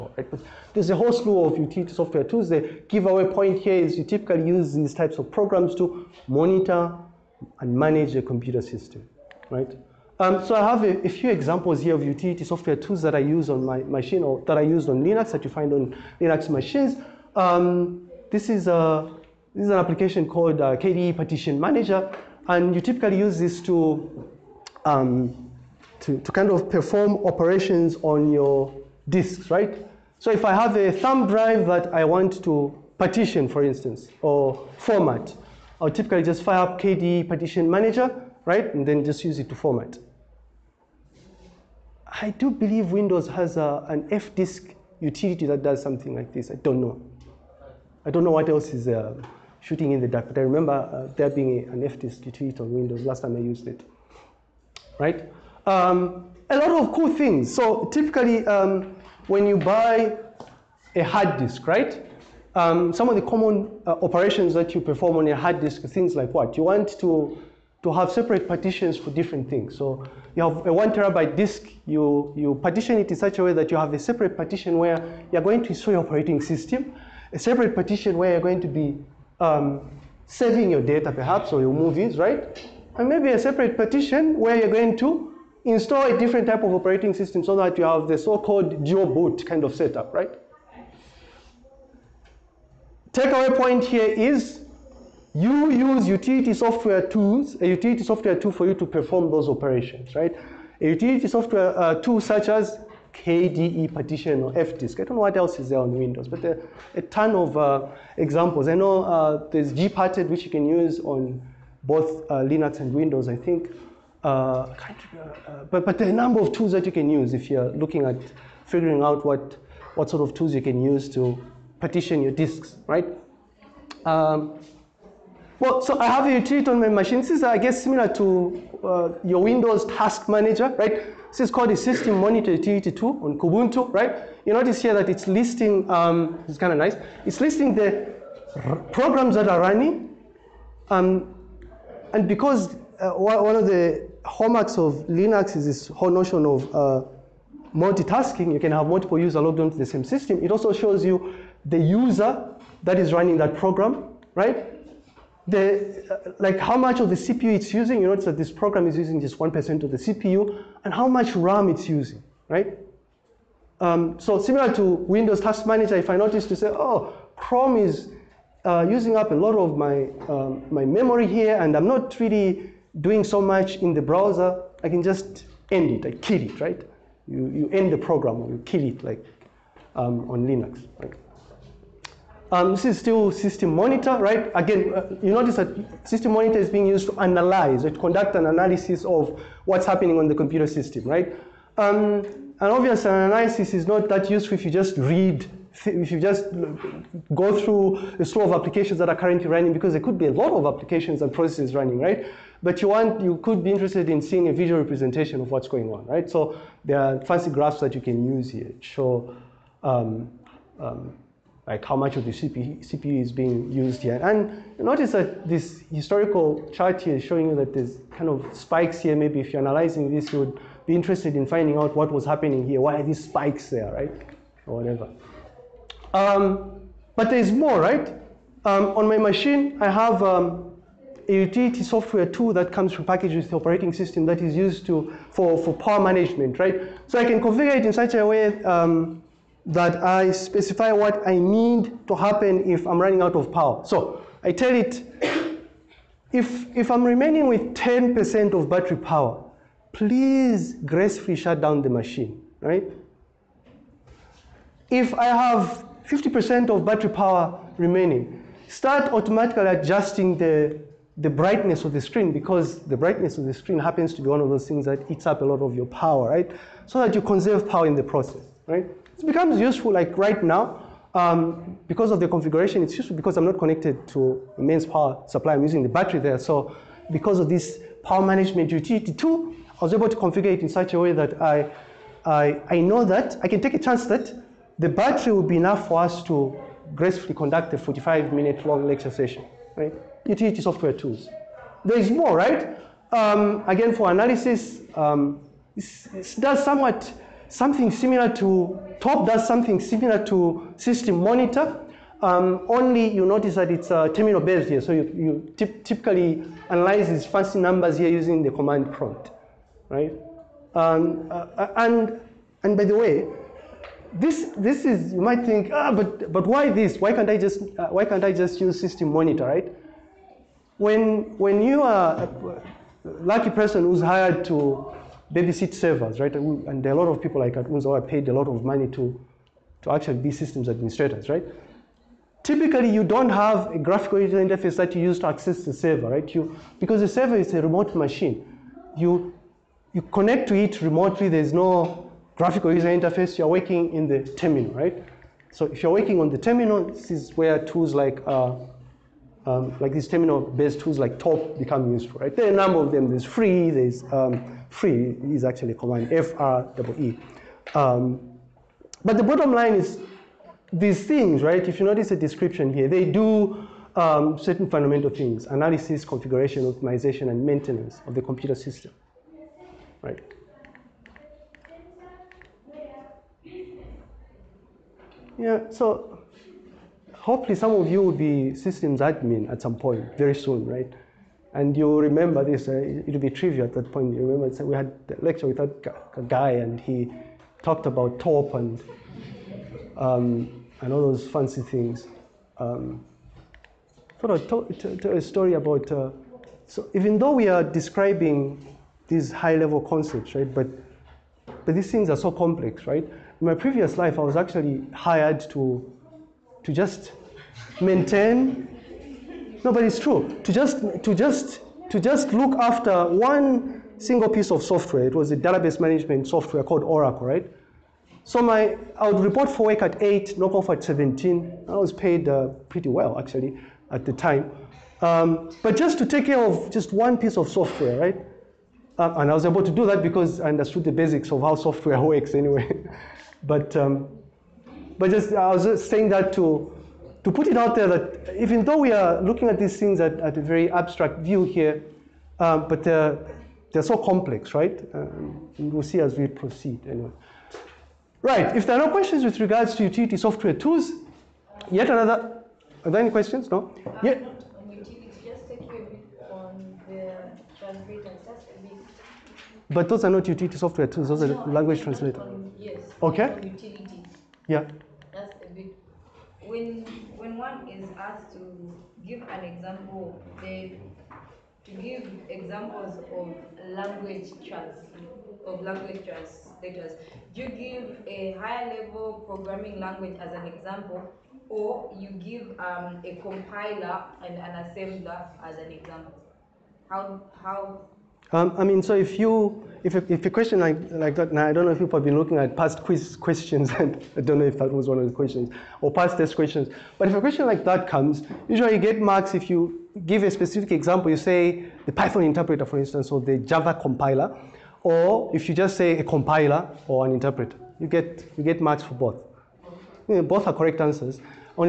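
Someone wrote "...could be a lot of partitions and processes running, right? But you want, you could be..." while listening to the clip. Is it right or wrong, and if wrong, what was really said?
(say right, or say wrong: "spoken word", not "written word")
wrong: "applications", not "partitions".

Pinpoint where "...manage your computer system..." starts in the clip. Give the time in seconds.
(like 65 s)
7 s.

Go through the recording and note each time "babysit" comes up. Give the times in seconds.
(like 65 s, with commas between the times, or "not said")
325 s.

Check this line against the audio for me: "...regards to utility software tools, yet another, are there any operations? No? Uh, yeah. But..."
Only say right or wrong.
wrong.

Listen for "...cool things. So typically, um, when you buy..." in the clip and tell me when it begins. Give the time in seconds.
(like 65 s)
56 s.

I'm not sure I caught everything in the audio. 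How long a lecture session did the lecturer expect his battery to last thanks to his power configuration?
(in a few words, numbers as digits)
45 minutes.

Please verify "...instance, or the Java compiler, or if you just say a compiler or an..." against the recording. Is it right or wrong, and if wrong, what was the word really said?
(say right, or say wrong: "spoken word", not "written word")
right.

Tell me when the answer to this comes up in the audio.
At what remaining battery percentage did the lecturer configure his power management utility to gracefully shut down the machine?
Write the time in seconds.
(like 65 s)
247 s.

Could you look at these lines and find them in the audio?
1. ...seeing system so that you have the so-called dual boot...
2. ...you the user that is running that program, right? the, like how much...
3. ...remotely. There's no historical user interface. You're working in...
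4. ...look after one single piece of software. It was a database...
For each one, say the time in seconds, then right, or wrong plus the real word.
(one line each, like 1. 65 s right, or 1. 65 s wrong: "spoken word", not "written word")
1. 86 s wrong: "operating", not "seeing"
2. 151 s right
3. 340 s wrong: "graphical", not "historical"
4. 412 s right.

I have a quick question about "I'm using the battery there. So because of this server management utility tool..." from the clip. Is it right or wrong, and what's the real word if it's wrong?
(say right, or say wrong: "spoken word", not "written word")
wrong: "power", not "server".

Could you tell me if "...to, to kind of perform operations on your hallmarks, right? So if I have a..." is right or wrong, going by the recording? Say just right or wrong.
wrong.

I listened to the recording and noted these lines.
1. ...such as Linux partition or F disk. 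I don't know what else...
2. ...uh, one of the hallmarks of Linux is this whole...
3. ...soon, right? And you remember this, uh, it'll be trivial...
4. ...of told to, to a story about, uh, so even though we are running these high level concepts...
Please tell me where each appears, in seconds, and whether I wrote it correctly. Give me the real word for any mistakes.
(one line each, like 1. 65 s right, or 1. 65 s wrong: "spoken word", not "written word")
1. 102 s wrong: "KDE", not "Linux"
2. 142 s right
3. 380 s right
4. 394 s wrong: "describing", not "running".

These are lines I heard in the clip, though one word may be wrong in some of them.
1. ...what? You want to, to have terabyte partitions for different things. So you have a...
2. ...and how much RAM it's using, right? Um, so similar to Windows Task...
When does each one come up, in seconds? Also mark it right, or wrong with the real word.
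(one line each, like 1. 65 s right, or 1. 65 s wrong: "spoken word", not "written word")
1. 66 s wrong: "separate", not "terabyte"
2. 160 s right.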